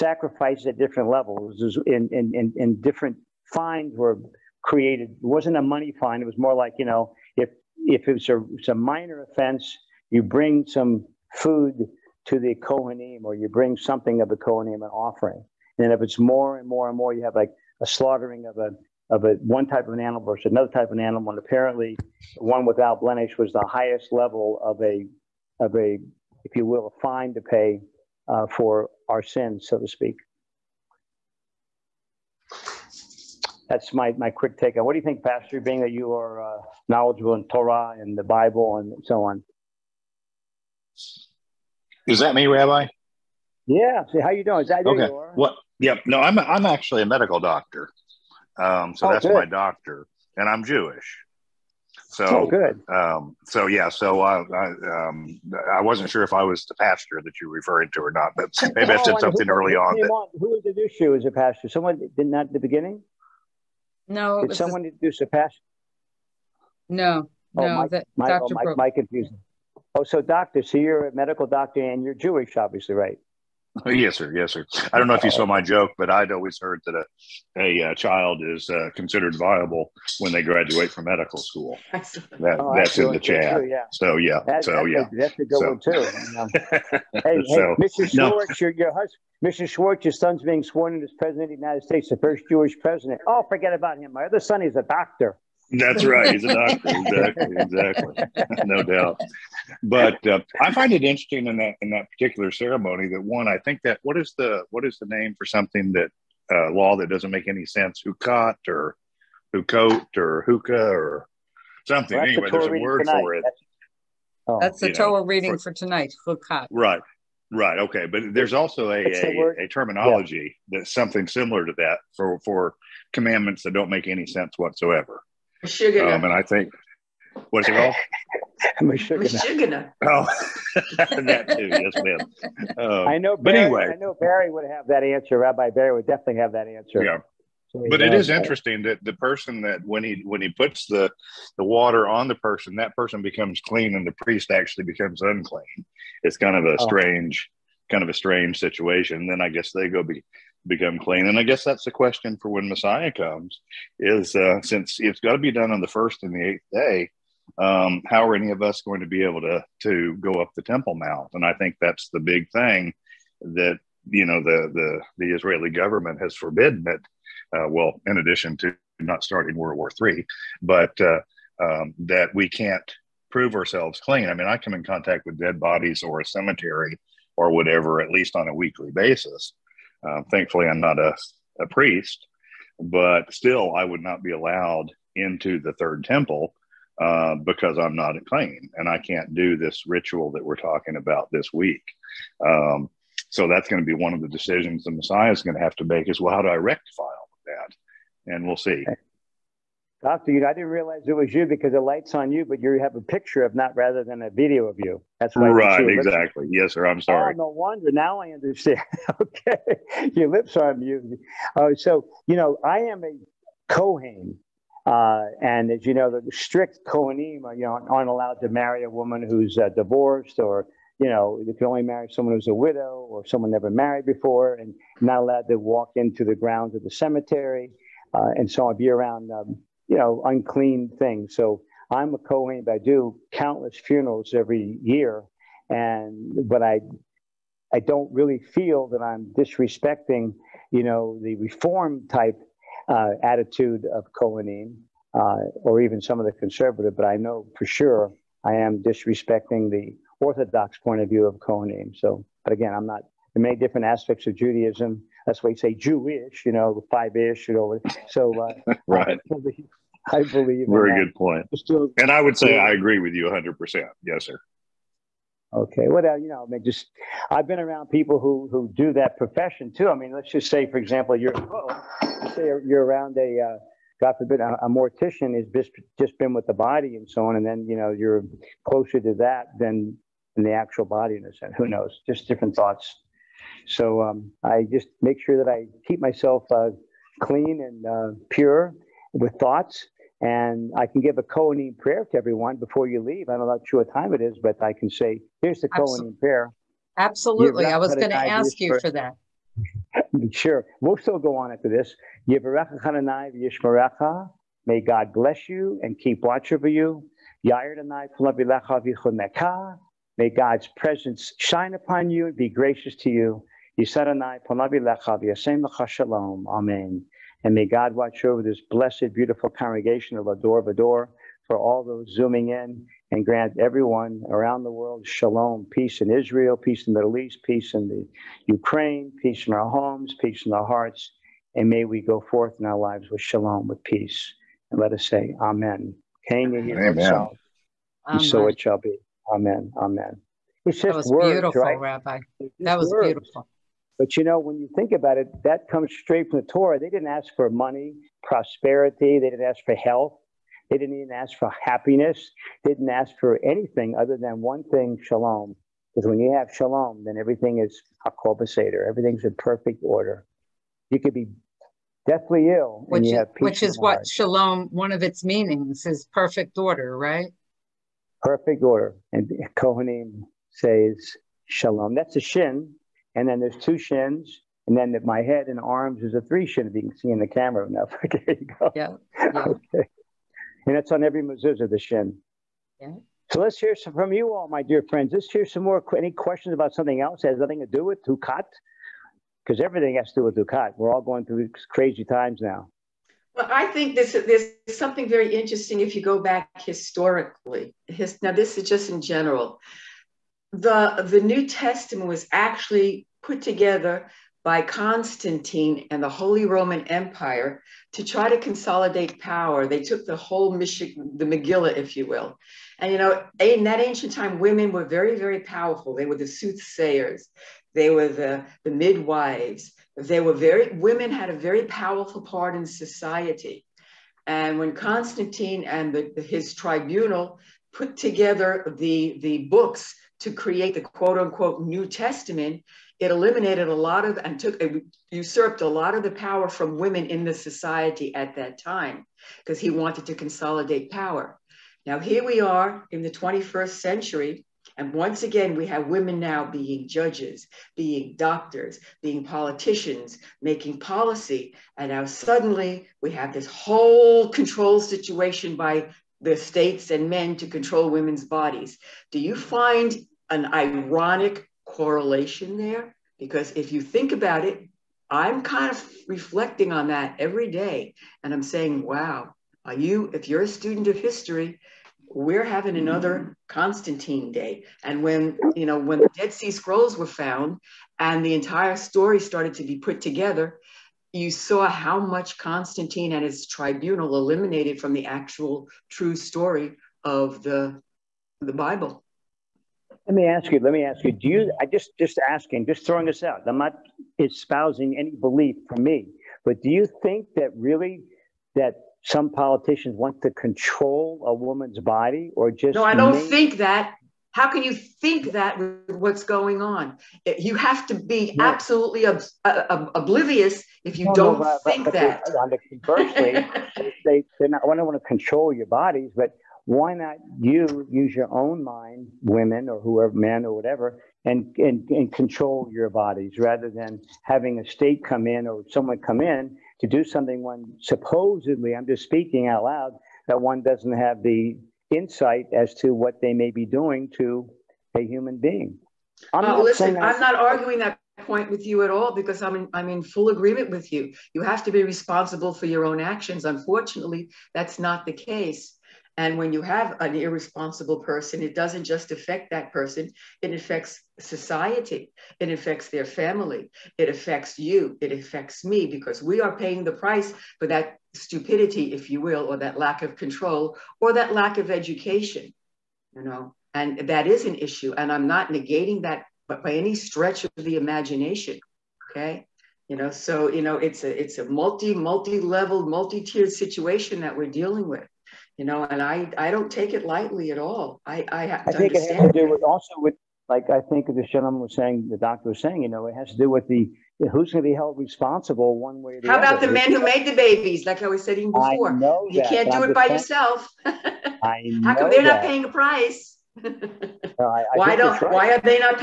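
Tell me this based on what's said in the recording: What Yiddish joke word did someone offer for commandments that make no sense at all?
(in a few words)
Meshuggah.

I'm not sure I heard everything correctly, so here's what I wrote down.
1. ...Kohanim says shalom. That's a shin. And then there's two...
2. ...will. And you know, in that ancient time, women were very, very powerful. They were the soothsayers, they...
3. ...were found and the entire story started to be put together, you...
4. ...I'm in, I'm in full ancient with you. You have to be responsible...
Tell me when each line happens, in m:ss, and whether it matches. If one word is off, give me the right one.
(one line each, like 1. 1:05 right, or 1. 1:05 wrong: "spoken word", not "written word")
1. 6:09 right
2. 6:52 right
3. 7:56 right
4. 8:59 wrong: "agreement", not "ancient".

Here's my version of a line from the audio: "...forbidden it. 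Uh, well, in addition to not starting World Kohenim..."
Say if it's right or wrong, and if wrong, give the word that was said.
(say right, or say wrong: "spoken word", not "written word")
wrong: "War", not "Kohenim".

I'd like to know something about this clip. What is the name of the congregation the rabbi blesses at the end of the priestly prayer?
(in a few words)
L'Dor Va-Dor.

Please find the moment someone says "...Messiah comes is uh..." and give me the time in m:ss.
2:32.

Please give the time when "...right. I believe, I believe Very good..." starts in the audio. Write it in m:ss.
4:18.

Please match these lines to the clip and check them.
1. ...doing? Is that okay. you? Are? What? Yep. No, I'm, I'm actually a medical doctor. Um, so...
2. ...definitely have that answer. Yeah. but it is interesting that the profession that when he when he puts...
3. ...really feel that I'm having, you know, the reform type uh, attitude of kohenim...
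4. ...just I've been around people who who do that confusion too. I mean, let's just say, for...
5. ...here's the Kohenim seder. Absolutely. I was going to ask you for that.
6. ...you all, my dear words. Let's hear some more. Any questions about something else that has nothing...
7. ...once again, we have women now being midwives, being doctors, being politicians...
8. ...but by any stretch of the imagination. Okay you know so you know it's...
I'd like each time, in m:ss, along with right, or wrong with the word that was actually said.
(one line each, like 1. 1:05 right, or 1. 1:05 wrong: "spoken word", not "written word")
1. 0:44 right
2. 2:16 wrong: "person", not "profession"
3. 3:58 wrong: "disrespecting", not "having"
4. 4:26 wrong: "profession", not "confusion"
5. 4:55 wrong: "prayer", not "seder"
6. 6:24 wrong: "friends", not "words"
7. 7:24 wrong: "judges", not "midwives"
8. 9:26 right.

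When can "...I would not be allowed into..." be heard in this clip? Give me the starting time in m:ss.
3:03.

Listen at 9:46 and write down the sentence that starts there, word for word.
How about the men who made the babies, like I was saying before?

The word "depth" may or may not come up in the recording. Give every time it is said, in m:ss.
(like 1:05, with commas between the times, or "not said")
not said.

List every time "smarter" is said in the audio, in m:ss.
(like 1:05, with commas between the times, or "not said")
not said.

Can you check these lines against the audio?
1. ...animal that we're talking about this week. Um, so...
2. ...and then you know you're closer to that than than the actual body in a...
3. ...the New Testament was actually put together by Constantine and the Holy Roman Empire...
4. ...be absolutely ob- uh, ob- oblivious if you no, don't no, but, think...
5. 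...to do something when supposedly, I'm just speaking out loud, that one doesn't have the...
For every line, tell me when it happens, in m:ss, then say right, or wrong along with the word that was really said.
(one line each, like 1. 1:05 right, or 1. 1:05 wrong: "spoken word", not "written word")
1. 3:09 wrong: "ritual", not "animal"
2. 4:37 right
3. 6:41 right
4. 8:27 right
5. 8:46 right.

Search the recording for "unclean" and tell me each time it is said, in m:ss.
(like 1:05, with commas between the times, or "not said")
2:25, 3:50.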